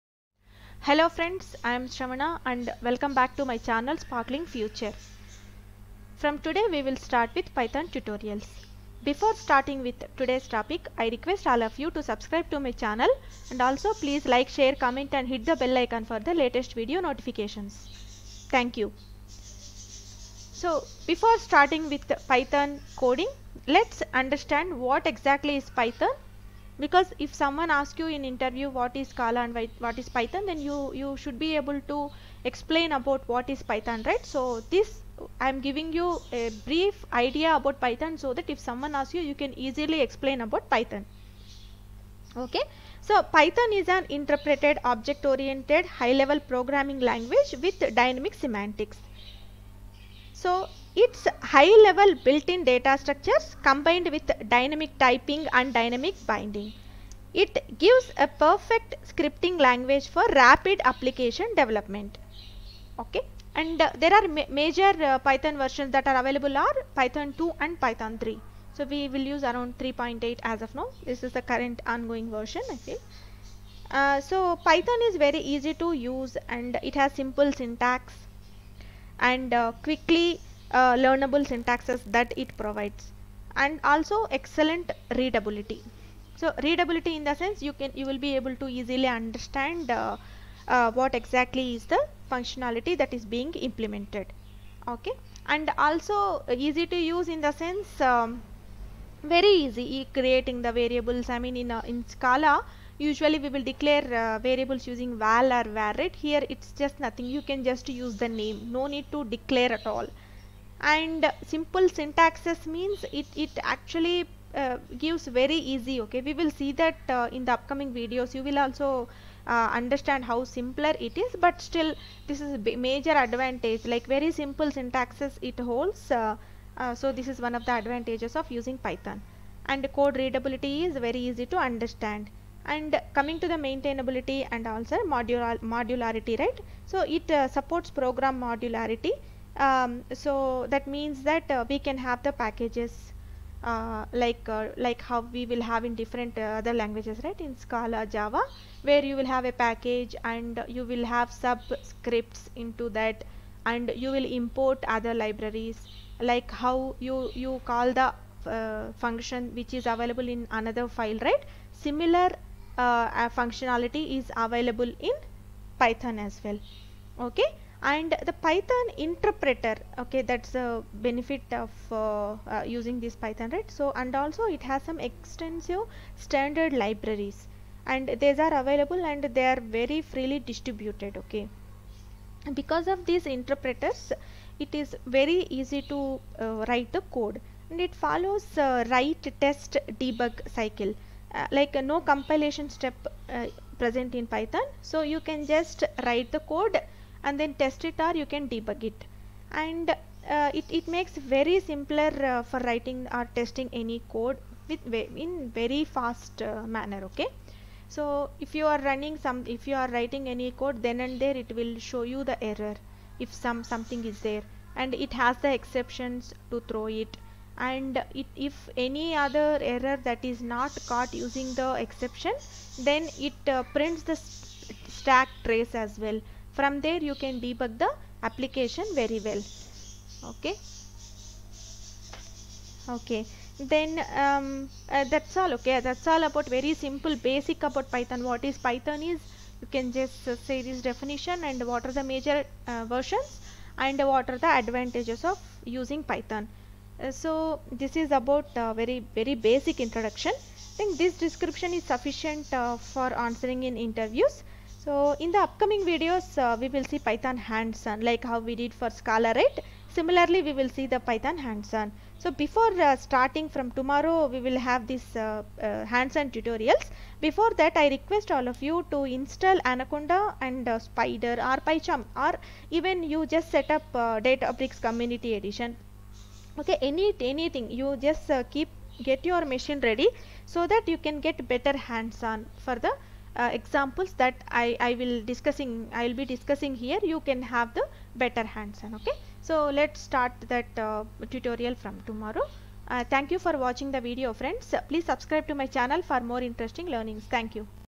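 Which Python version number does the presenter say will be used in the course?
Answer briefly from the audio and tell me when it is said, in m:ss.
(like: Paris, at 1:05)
3.8, at 1:09.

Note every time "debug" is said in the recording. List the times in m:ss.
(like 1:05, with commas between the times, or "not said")
3:09, 3:18, 3:47.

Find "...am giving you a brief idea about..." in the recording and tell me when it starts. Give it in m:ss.
0:35.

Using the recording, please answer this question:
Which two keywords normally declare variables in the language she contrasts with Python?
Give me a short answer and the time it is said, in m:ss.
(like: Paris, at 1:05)
val or var, at 1:45.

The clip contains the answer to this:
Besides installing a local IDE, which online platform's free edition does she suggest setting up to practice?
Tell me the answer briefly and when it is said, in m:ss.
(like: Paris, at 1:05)
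Databricks Community Edition, at 4:34.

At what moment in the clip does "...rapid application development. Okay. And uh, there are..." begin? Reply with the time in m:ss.
1:00.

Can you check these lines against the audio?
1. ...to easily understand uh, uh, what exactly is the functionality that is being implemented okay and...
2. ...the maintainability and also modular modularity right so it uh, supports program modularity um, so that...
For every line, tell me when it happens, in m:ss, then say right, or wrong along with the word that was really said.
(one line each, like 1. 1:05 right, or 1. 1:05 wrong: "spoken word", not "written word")
1. 1:28 right
2. 2:13 right.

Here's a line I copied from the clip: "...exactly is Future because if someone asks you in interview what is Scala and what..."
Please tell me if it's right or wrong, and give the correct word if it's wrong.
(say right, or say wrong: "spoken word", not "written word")
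wrong: "Python", not "Future".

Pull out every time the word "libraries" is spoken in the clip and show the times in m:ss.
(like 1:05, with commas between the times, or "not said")
2:35, 2:56.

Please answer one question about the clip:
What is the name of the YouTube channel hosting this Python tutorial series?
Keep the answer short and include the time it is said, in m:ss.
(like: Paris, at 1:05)
Sparkling Future, at 0:03.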